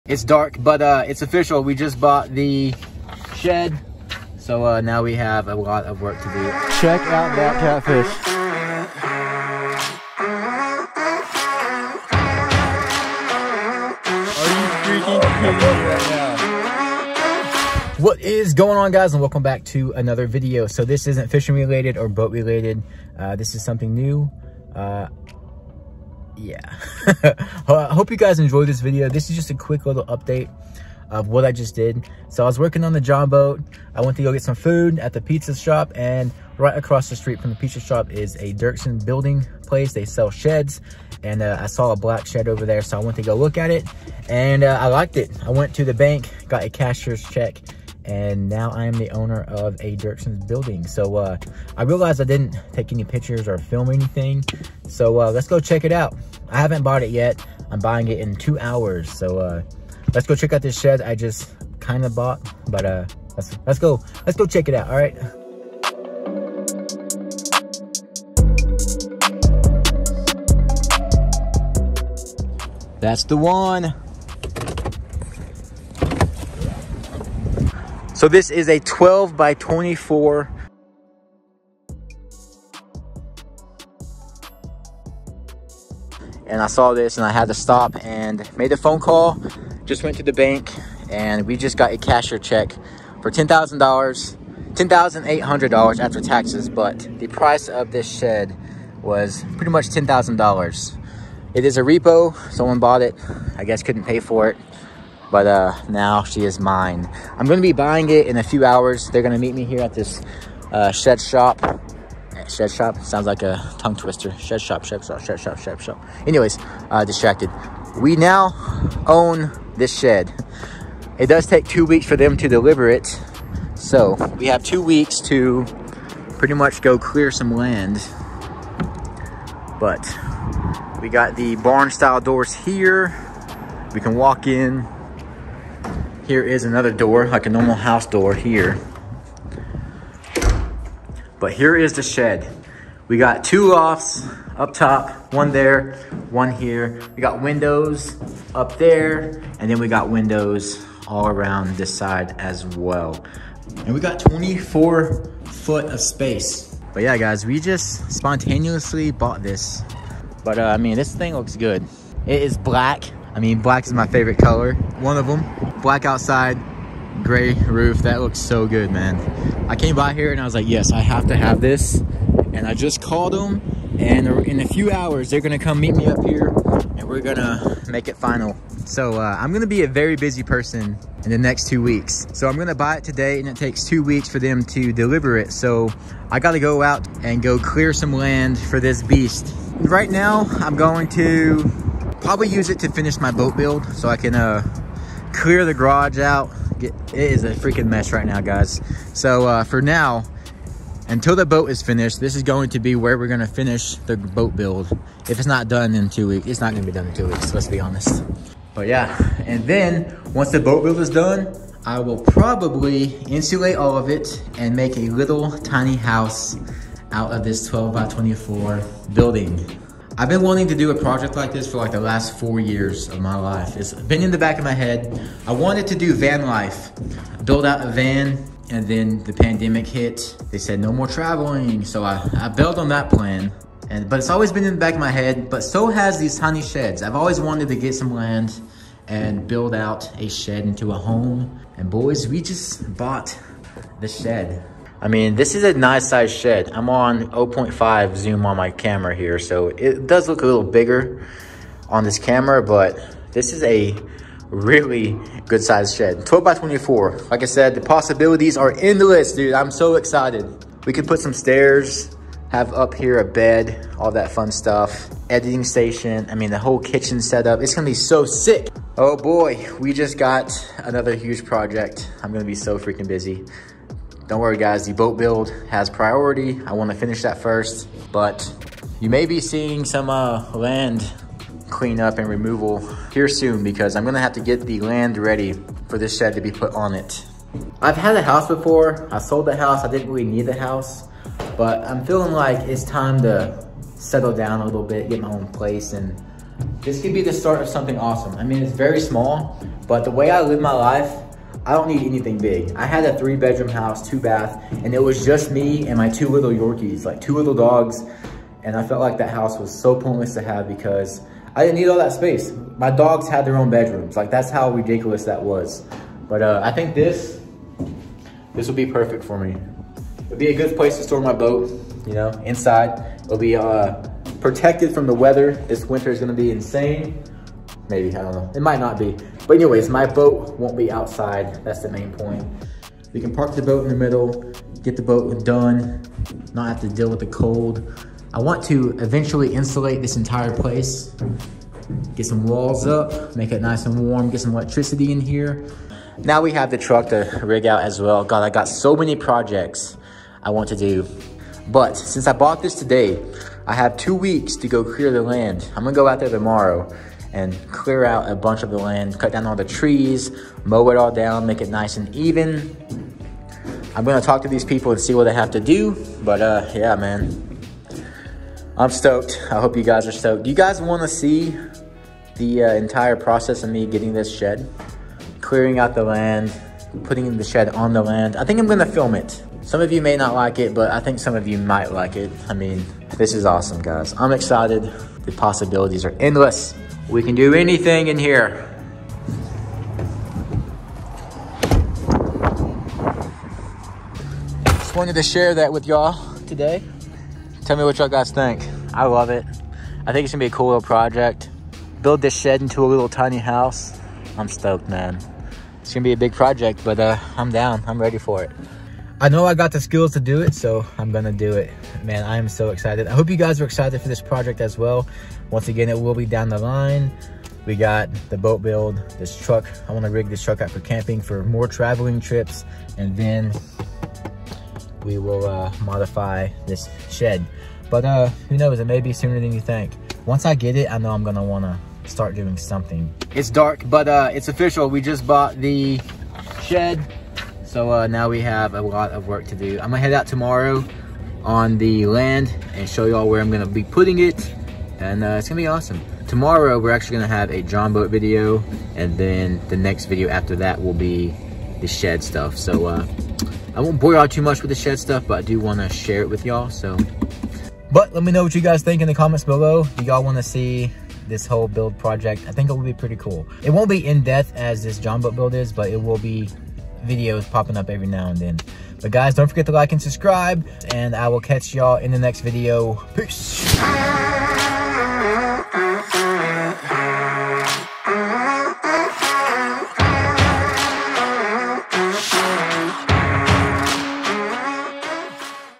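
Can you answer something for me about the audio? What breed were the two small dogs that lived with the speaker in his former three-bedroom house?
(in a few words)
Yorkies.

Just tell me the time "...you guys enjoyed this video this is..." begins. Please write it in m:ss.
0:28.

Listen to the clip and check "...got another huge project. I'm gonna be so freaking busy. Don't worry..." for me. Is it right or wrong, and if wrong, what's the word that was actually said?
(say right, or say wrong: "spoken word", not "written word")
right.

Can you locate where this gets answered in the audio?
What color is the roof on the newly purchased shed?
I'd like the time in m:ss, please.
2:47.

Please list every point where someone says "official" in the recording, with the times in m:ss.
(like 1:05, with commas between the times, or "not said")
0:01, 7:14.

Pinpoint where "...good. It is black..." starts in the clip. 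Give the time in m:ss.
2:41.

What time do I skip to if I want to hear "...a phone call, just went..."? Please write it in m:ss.
1:28.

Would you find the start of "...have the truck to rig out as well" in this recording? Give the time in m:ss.
5:46.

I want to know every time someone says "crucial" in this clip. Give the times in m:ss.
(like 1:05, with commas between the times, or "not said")
not said.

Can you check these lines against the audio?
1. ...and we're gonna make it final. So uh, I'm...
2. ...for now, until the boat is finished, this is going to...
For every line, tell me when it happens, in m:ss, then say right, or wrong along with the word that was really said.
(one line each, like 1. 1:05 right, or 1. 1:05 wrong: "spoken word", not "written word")
1. 2:56 right
2. 3:19 right.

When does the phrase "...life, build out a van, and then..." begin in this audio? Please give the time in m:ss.
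3:46.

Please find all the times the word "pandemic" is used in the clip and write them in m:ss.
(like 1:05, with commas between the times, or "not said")
3:49.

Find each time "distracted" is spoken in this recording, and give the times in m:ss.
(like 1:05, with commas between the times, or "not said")
1:57.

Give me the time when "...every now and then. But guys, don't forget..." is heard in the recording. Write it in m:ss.
7:47.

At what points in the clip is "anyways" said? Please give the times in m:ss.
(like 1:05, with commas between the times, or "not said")
1:56, 5:29.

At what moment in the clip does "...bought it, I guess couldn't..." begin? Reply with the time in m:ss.
1:42.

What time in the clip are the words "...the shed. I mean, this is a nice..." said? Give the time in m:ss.
4:04.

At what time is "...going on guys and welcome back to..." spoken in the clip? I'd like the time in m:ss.
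0:18.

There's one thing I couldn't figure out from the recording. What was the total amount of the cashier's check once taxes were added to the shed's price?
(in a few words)
$10,800.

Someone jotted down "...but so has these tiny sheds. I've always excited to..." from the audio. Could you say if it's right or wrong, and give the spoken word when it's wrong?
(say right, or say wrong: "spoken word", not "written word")
wrong: "wanted", not "excited".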